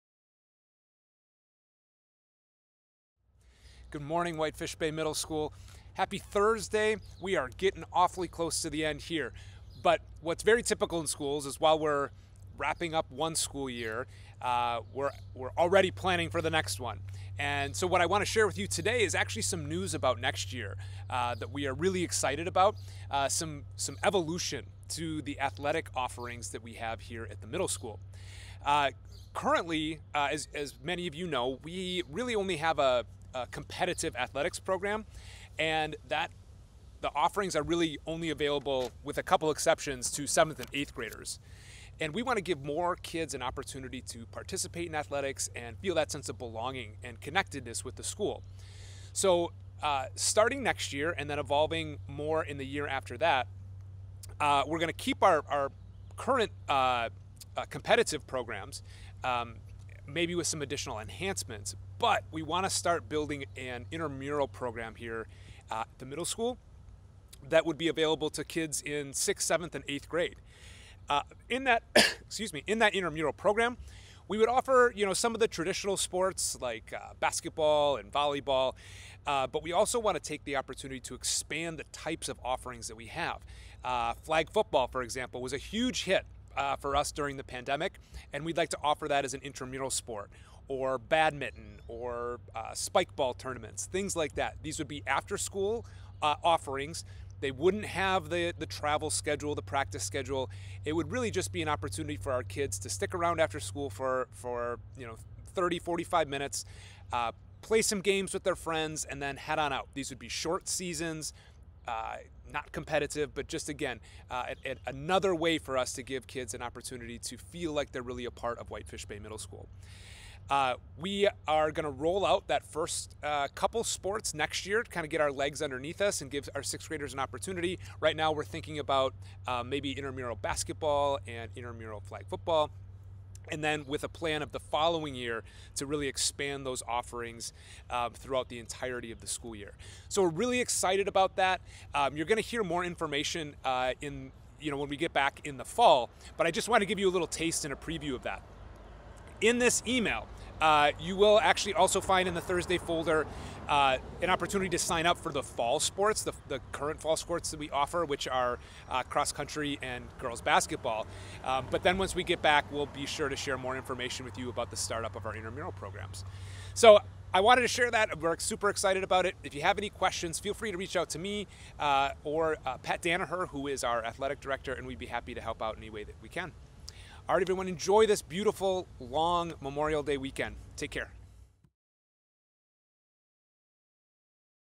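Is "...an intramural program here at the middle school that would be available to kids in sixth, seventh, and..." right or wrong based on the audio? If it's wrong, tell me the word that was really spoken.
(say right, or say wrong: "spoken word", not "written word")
right.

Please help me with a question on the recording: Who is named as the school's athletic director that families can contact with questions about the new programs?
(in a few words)
Pat Danaher.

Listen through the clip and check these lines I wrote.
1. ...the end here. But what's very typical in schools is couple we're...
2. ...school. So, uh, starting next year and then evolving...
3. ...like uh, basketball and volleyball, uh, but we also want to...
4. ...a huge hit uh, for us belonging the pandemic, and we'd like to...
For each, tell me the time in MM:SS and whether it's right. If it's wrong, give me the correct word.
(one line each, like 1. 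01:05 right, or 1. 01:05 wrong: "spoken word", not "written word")
1. 00:08 wrong: "while", not "couple"
2. 00:48 right
3. 01:16 right
4. 01:25 wrong: "during", not "belonging".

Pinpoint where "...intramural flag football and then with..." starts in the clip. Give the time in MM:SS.
02:11.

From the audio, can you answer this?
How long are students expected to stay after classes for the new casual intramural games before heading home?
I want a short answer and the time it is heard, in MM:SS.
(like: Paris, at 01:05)
30 to 45 minutes, at 01:45.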